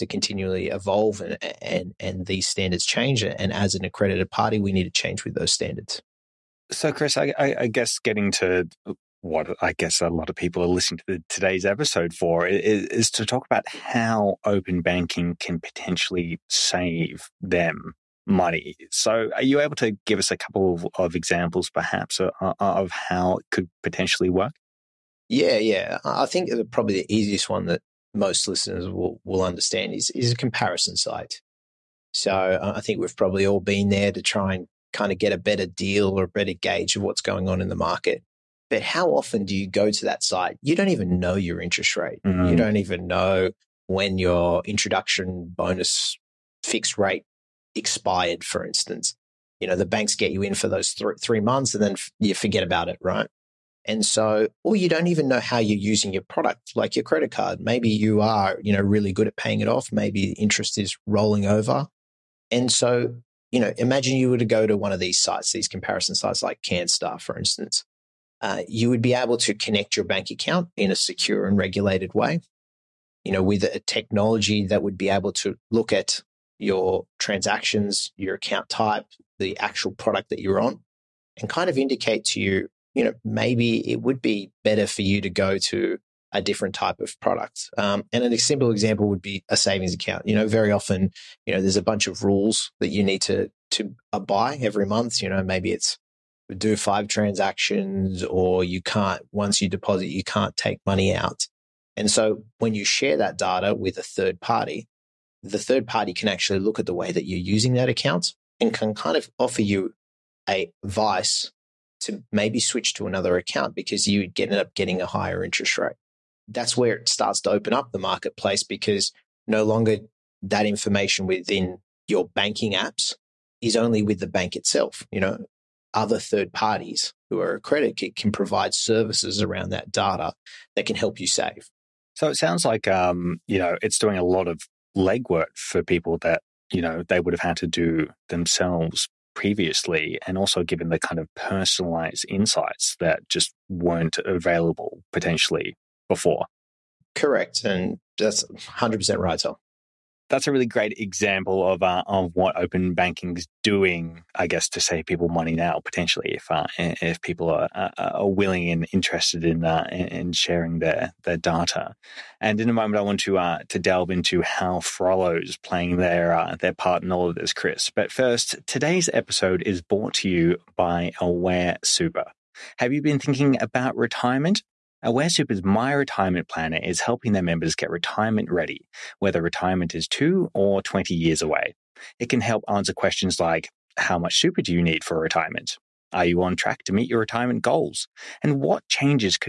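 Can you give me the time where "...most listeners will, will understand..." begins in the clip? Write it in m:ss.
0:28.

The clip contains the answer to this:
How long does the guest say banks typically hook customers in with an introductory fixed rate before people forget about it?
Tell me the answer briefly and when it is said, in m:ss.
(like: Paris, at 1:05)
3 months, at 0:51.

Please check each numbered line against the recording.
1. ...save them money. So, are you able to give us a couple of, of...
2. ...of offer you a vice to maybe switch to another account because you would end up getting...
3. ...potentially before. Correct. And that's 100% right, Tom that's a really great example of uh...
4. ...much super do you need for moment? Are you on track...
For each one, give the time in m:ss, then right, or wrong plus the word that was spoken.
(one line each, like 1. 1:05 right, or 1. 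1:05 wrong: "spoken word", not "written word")
1. 0:16 right
2. 1:49 right
3. 2:25 right
4. 3:04 wrong: "retirement", not "moment".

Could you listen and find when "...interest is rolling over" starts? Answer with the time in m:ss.
1:00.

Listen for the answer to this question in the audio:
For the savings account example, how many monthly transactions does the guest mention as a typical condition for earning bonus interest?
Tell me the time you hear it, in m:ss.
1:36.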